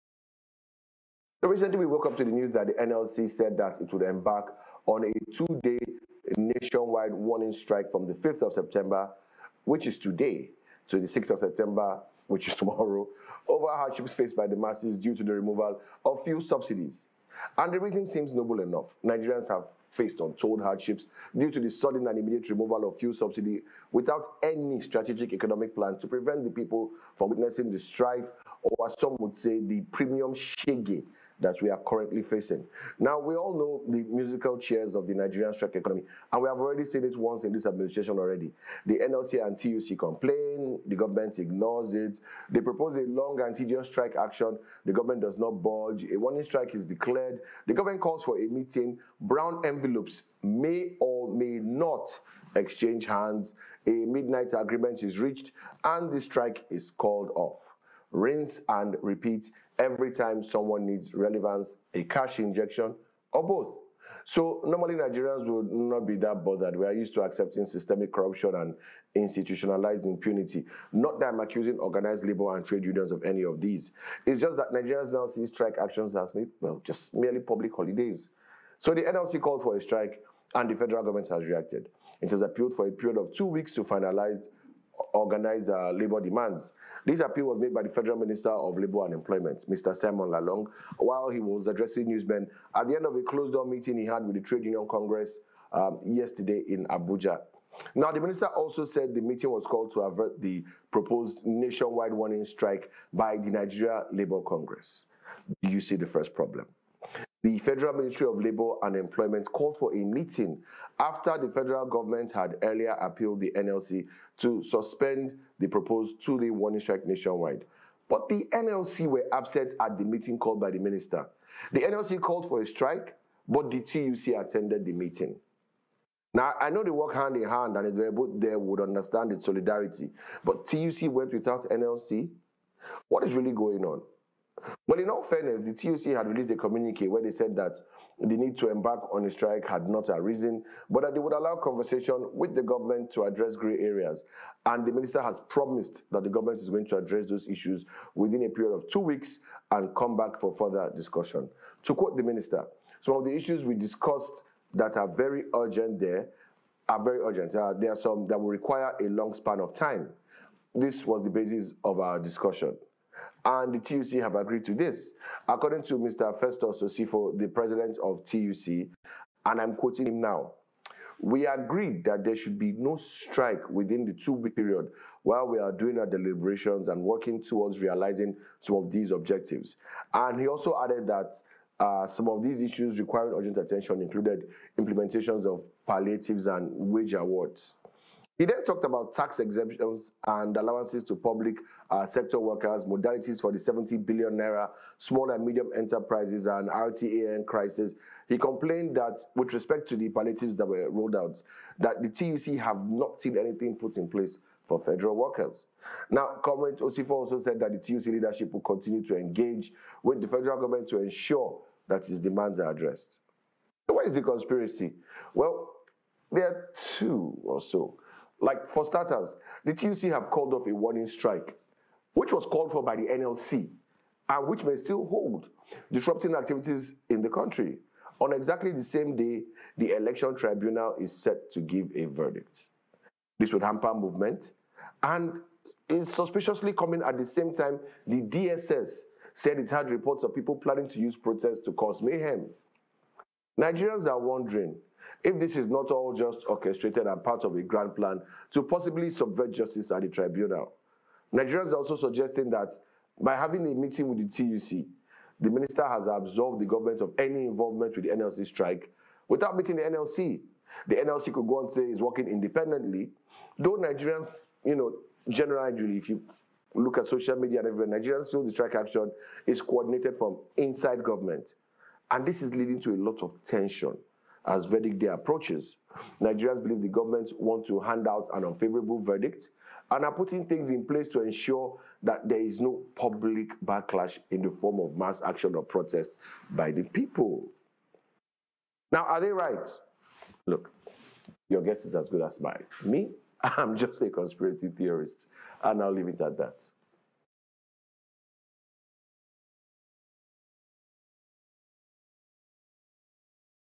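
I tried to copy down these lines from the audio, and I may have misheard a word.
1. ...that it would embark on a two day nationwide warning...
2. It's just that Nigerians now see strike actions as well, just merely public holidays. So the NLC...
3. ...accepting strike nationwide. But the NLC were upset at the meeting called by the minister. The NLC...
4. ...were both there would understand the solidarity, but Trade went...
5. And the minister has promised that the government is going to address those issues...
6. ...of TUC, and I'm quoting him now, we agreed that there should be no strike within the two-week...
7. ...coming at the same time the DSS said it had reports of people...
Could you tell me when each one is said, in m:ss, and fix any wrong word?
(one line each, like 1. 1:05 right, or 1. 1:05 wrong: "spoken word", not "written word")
1. 0:03 right
2. 1:14 right
3. 1:56 wrong: "warning", not "accepting"
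4. 2:08 wrong: "TUC", not "Trade"
5. 2:24 right
6. 2:48 right
7. 3:56 right.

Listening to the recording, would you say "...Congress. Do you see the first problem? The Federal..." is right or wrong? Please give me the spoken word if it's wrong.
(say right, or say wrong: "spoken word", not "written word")
right.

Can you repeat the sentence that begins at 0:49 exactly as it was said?
Brown envelopes may or may not exchange hands.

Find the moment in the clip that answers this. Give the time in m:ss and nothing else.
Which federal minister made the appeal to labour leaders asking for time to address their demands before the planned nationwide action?
1:29.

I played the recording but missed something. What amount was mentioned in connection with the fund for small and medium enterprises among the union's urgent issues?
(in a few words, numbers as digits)
70 billion naira.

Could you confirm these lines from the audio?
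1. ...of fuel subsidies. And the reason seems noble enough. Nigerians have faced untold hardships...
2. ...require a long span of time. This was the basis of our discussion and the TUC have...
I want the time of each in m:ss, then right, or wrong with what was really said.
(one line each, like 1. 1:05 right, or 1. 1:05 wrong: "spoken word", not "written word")
1. 0:16 right
2. 2:38 right.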